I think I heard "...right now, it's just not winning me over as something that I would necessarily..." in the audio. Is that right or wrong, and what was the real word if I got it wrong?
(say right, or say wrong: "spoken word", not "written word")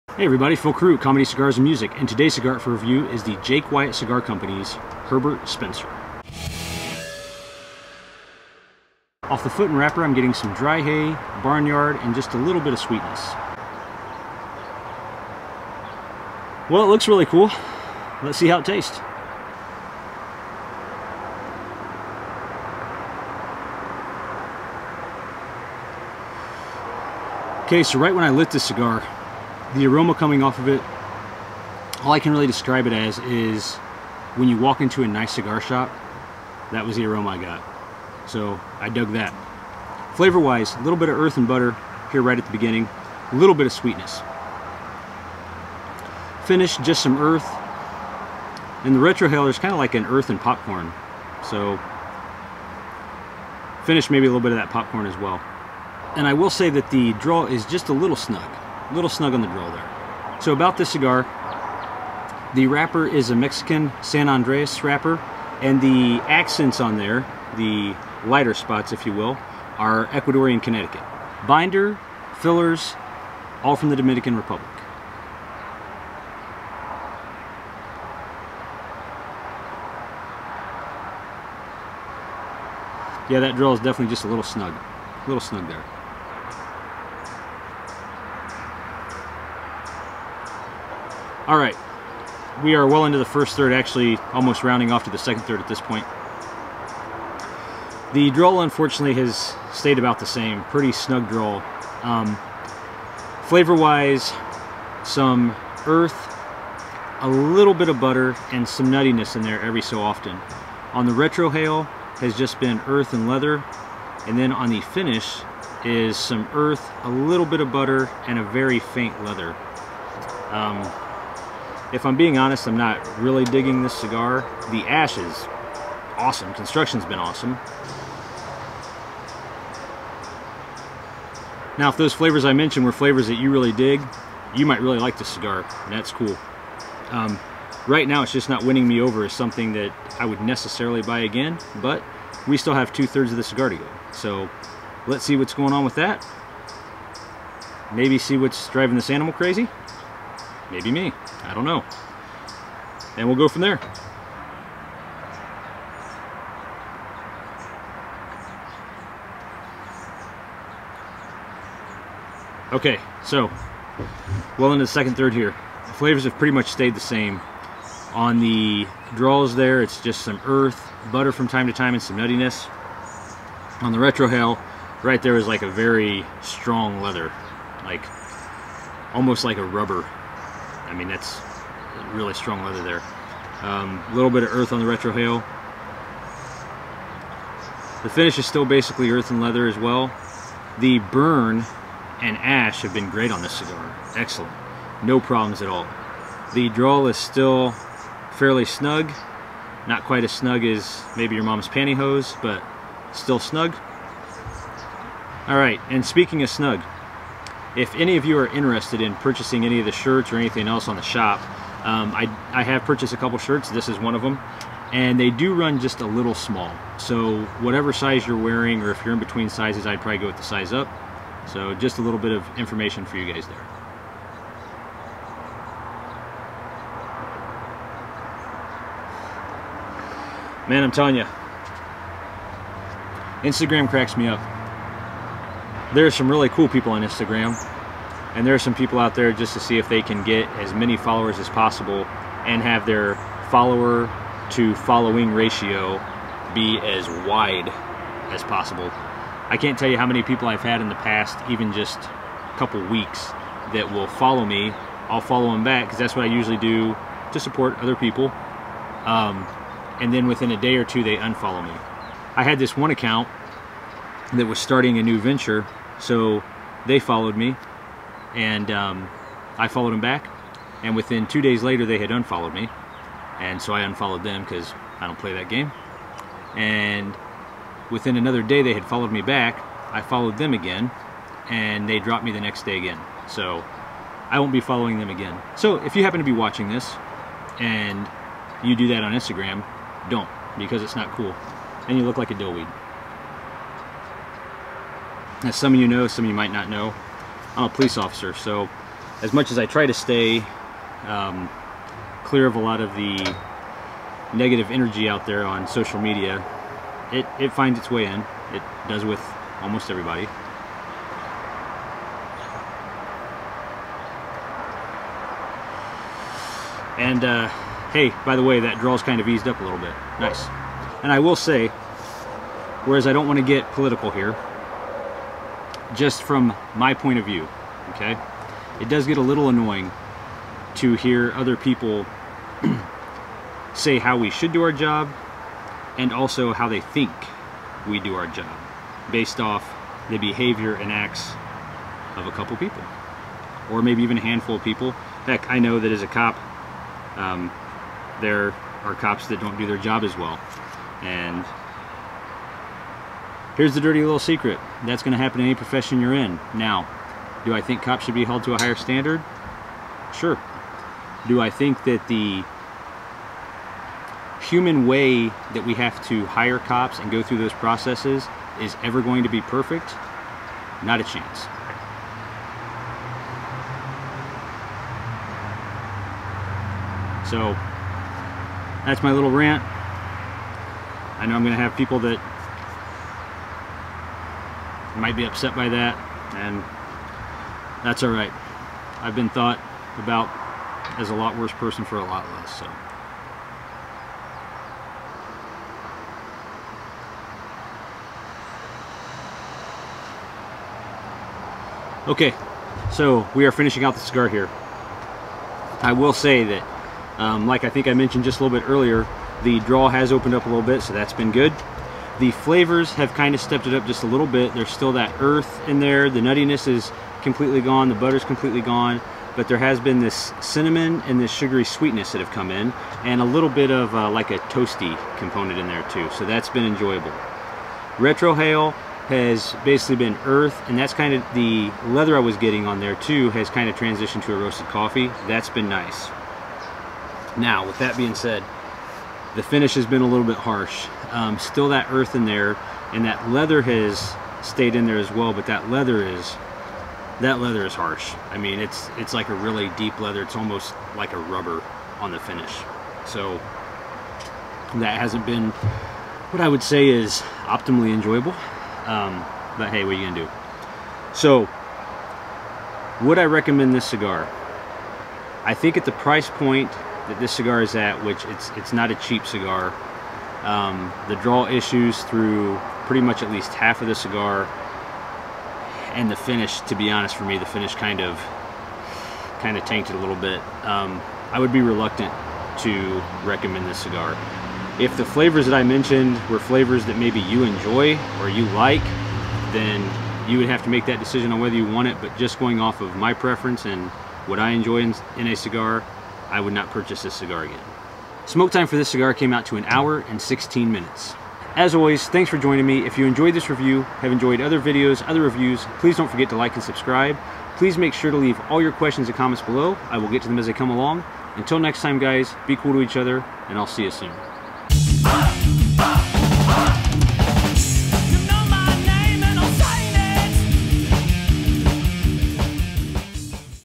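right.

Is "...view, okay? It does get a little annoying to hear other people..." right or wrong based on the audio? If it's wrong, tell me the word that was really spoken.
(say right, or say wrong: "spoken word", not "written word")
right.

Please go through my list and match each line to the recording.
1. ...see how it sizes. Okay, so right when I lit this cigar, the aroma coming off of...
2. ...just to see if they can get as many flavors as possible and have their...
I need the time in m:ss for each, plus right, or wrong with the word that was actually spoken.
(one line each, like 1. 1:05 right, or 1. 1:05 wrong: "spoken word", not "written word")
1. 0:18 wrong: "tastes", not "sizes"
2. 3:59 wrong: "followers", not "flavors".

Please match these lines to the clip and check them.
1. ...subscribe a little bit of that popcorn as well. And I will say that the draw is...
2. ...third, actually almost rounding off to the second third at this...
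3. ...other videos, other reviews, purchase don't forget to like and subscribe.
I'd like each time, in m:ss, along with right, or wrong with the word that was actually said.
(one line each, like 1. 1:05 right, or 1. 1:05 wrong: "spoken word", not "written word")
1. 0:54 wrong: "maybe", not "subscribe"
2. 1:33 right
3. 8:24 wrong: "please", not "purchase".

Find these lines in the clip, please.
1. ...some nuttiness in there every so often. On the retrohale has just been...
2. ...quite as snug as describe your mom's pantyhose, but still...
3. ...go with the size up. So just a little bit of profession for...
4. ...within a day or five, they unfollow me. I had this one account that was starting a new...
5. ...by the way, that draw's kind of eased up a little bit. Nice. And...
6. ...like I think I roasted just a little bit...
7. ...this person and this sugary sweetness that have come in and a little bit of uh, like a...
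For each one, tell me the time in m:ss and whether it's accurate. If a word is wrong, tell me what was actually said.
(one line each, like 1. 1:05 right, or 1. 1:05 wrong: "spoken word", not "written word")
1. 1:48 right
2. 3:20 wrong: "maybe", not "describe"
3. 3:40 wrong: "information", not "profession"
4. 4:20 wrong: "two", not "five"
5. 5:18 right
6. 6:47 wrong: "mentioned", not "roasted"
7. 7:00 wrong: "cinnamon", not "person".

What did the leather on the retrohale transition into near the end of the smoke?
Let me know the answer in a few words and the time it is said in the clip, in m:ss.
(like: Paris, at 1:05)
roasted coffee, at 7:14.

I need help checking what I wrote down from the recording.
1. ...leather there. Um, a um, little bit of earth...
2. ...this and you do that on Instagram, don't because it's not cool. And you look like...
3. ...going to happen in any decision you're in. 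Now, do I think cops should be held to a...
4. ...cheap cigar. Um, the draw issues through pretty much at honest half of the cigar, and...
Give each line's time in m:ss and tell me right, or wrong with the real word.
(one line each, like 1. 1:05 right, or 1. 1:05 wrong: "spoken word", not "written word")
1. 3:02 right
2. 4:46 right
3. 5:55 wrong: "profession", not "decision"
4. 7:48 wrong: "least", not "honest".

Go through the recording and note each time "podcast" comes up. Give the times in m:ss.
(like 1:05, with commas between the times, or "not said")
not said.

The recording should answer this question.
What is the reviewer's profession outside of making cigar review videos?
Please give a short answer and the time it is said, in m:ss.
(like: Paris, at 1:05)
police officer, at 4:57.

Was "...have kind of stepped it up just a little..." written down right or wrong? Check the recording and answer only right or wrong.
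right.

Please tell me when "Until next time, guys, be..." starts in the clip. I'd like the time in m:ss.
8:31.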